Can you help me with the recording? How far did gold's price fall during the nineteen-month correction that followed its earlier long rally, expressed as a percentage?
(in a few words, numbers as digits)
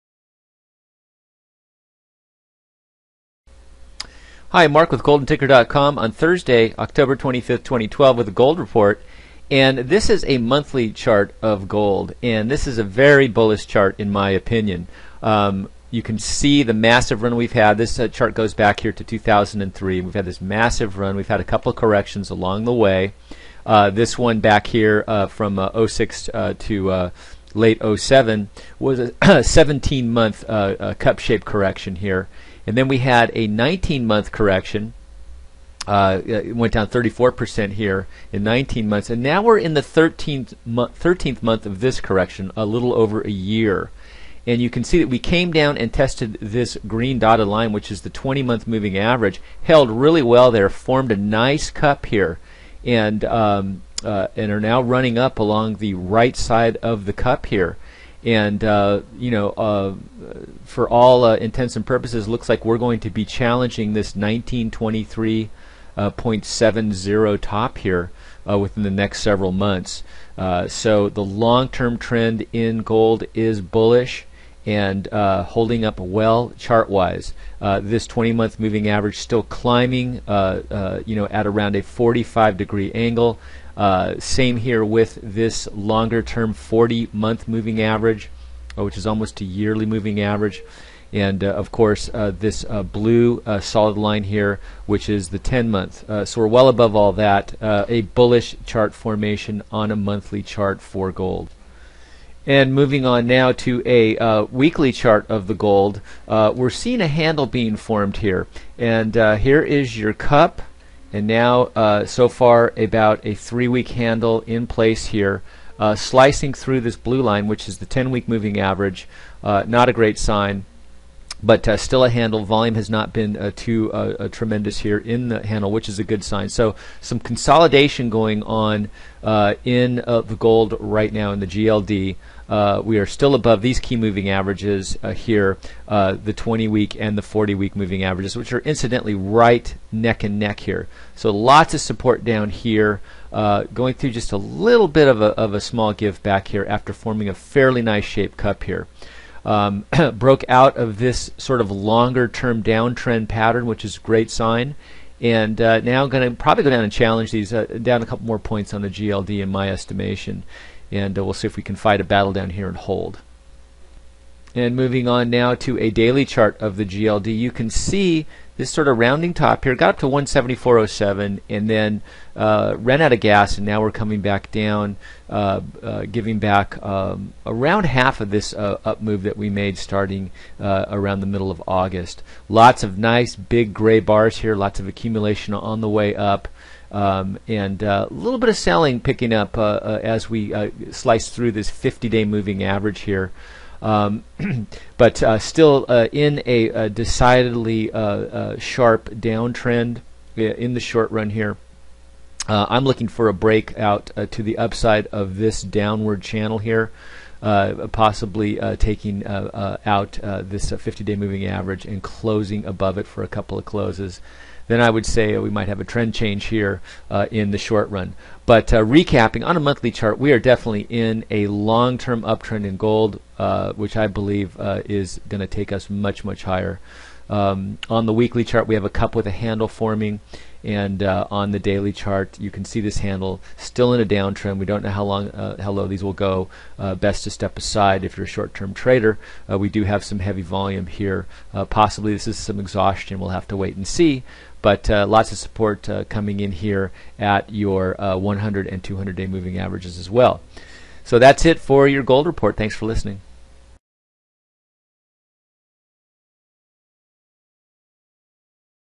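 34%.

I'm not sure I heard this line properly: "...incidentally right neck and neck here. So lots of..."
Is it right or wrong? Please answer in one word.
right.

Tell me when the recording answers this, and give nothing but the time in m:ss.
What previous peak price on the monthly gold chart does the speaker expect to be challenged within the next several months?
1:04.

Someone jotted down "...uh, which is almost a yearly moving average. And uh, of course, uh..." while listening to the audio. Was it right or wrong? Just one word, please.
right.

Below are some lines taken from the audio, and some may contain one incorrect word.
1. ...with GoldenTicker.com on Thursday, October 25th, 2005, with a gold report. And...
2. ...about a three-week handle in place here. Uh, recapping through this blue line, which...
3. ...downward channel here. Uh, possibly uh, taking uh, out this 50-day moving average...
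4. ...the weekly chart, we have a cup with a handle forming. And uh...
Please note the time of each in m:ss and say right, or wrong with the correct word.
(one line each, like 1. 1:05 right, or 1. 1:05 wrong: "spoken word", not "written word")
1. 0:04 wrong: "2012", not "2005"
2. 1:52 wrong: "slicing", not "recapping"
3. 3:25 right
4. 3:48 right.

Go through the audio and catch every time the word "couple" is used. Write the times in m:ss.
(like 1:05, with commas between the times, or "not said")
0:21, 2:38, 3:33.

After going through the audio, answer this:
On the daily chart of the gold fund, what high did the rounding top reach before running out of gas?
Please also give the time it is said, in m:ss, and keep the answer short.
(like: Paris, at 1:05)
174.07, at 2:50.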